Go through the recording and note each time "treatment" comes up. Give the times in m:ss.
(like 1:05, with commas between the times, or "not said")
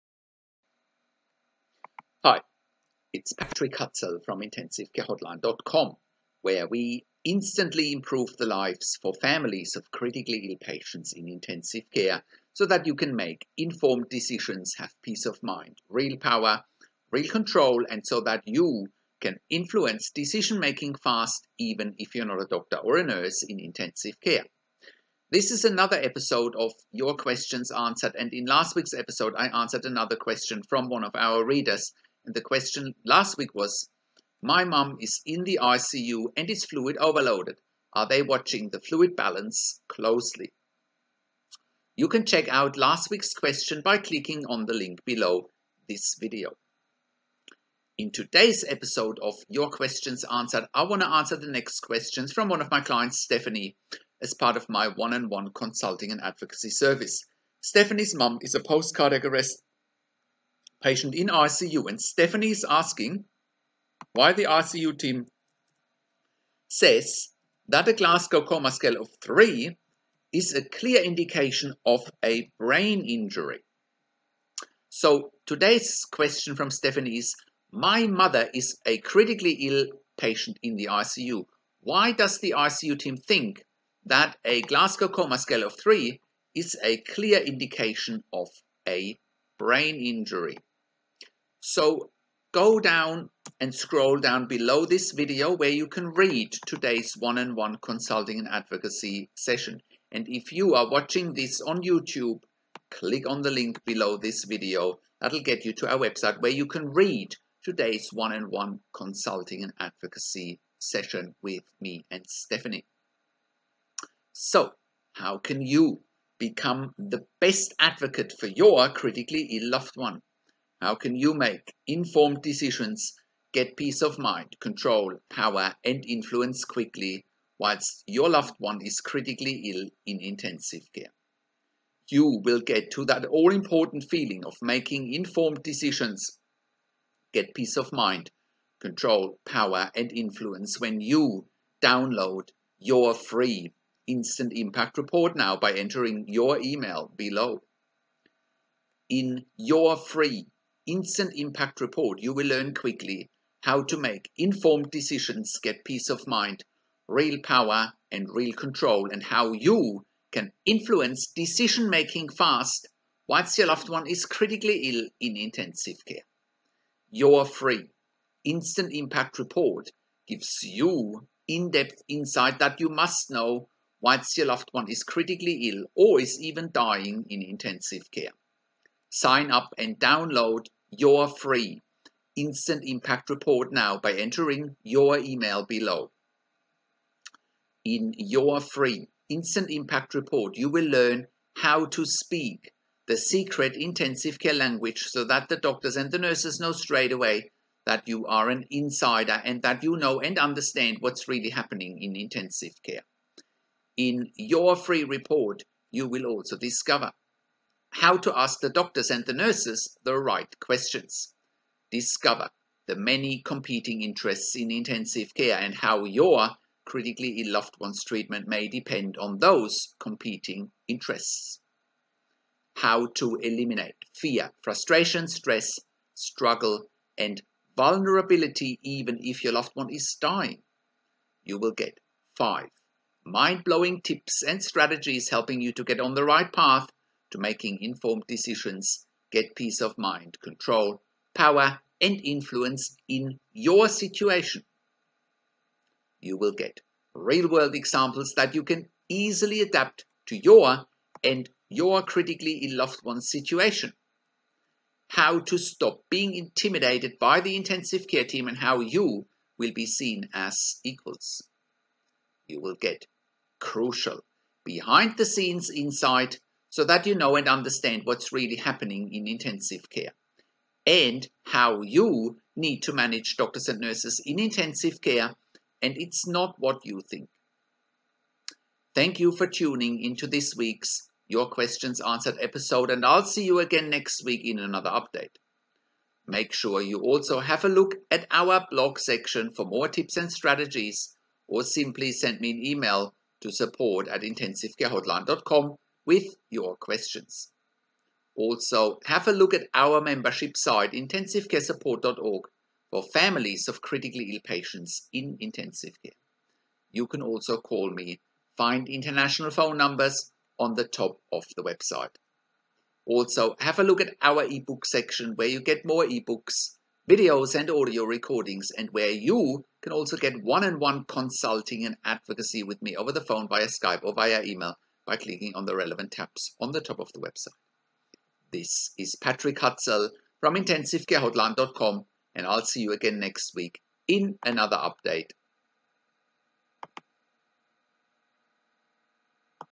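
3:38.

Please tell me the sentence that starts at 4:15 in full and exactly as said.
How to stop being intimidated by the intensive care team and how you will be seen as equals.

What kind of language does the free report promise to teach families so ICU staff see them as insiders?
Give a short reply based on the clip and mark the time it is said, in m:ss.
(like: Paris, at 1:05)
Secret intensive care language, at 3:13.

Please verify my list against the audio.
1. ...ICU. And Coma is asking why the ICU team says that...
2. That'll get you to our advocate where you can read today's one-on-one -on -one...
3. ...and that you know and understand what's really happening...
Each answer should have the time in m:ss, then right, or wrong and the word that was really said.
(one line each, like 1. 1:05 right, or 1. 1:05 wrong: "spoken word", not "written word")
1. 1:01 wrong: "Stephanie", not "Coma"
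2. 1:45 wrong: "website", not "advocate"
3. 3:19 right.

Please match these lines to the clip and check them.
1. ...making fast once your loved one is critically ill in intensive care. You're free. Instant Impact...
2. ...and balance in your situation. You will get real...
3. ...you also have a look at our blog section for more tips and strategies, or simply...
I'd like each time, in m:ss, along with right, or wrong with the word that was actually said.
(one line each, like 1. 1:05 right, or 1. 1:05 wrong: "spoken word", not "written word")
1. 2:41 right
2. 4:02 wrong: "influence", not "balance"
3. 4:46 right.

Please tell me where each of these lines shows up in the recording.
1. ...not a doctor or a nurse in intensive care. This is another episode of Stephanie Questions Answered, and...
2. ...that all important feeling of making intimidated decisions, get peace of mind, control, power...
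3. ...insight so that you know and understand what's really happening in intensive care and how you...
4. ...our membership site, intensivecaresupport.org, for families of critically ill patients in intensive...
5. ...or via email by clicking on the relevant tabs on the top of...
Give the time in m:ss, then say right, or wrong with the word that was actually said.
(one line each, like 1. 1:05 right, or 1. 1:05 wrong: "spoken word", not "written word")
1. 0:22 wrong: "Your", not "Stephanie"
2. 2:13 wrong: "informed", not "intimidated"
3. 4:25 right
4. 4:59 right
5. 5:24 right.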